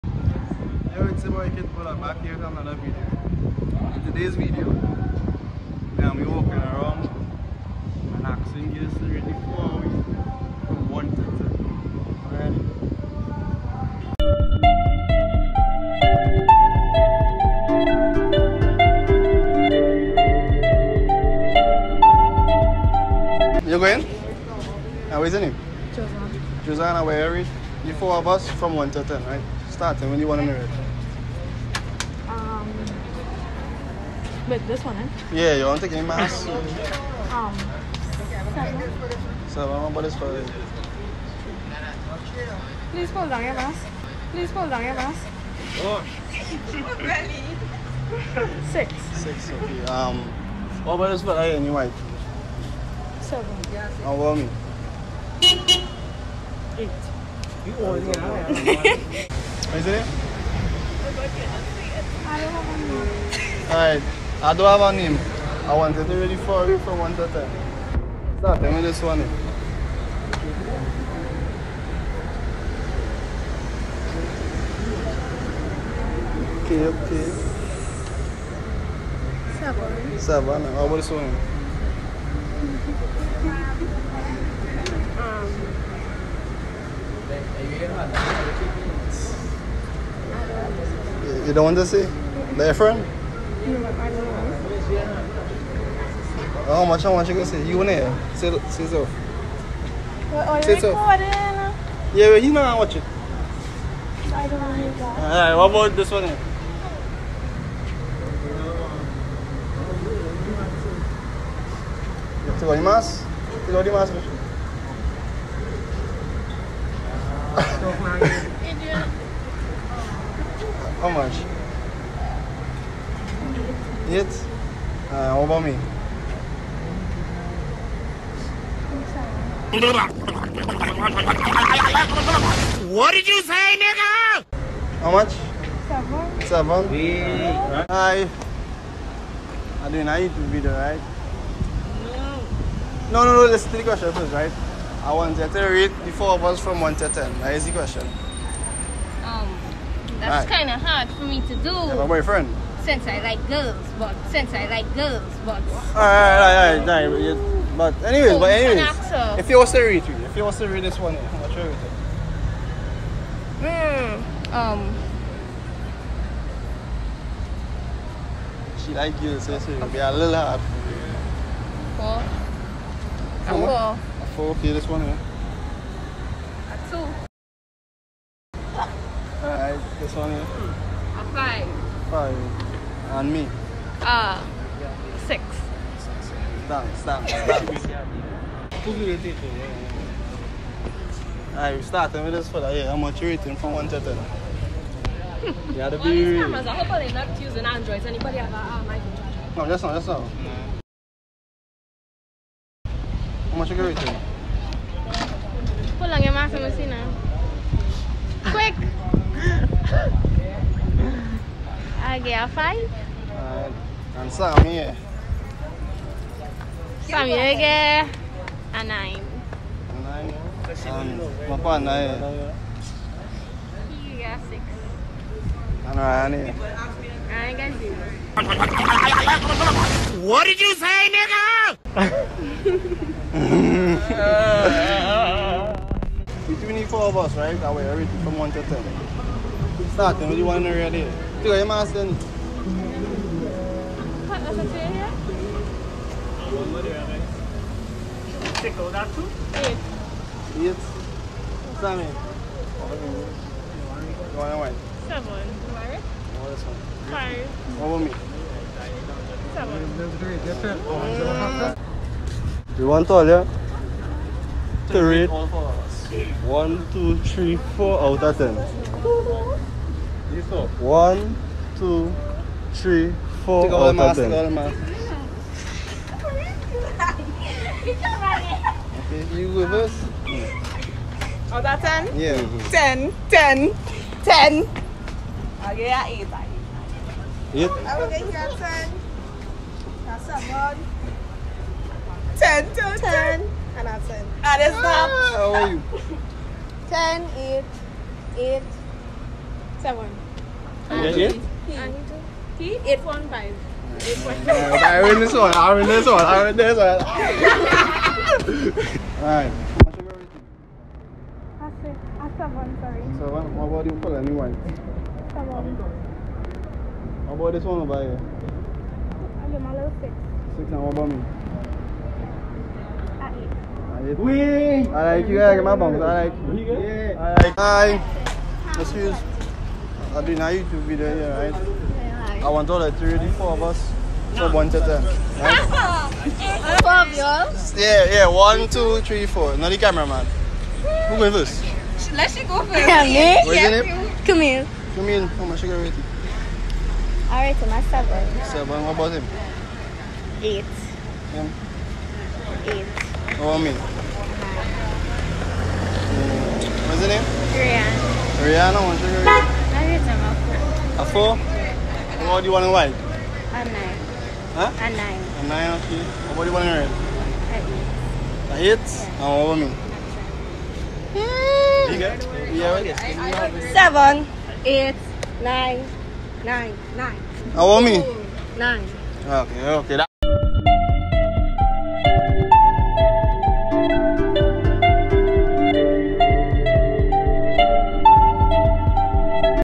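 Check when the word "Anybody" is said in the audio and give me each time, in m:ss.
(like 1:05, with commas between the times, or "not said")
3:18.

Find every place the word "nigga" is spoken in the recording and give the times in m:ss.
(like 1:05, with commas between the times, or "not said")
2:13, 3:51.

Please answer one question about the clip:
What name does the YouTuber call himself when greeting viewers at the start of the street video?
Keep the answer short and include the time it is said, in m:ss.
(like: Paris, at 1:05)
Kid Bodak, at 0:01.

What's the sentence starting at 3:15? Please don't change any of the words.
Yeah, the well, these cameras, I hope they're not using Androids.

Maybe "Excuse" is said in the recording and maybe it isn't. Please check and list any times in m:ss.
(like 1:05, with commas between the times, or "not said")
5:28.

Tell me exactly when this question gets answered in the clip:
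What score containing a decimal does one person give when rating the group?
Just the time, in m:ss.
5:02.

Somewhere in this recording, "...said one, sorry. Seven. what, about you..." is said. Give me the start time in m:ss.
5:12.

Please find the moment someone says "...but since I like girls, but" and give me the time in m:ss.
2:33.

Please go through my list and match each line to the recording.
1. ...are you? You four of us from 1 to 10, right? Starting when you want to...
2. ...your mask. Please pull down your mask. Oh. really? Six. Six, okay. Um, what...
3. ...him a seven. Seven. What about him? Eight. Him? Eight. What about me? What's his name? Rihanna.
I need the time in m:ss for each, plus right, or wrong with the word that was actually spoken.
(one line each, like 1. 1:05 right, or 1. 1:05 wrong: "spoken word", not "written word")
1. 0:27 right
2. 0:43 right
3. 5:47 right.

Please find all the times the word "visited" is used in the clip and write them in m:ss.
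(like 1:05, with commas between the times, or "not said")
not said.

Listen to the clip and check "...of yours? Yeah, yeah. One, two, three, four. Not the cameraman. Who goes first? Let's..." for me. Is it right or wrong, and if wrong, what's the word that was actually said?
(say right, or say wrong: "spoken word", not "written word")
right.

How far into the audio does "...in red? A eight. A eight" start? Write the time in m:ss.
6:06.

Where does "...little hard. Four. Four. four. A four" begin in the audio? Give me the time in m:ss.
2:50.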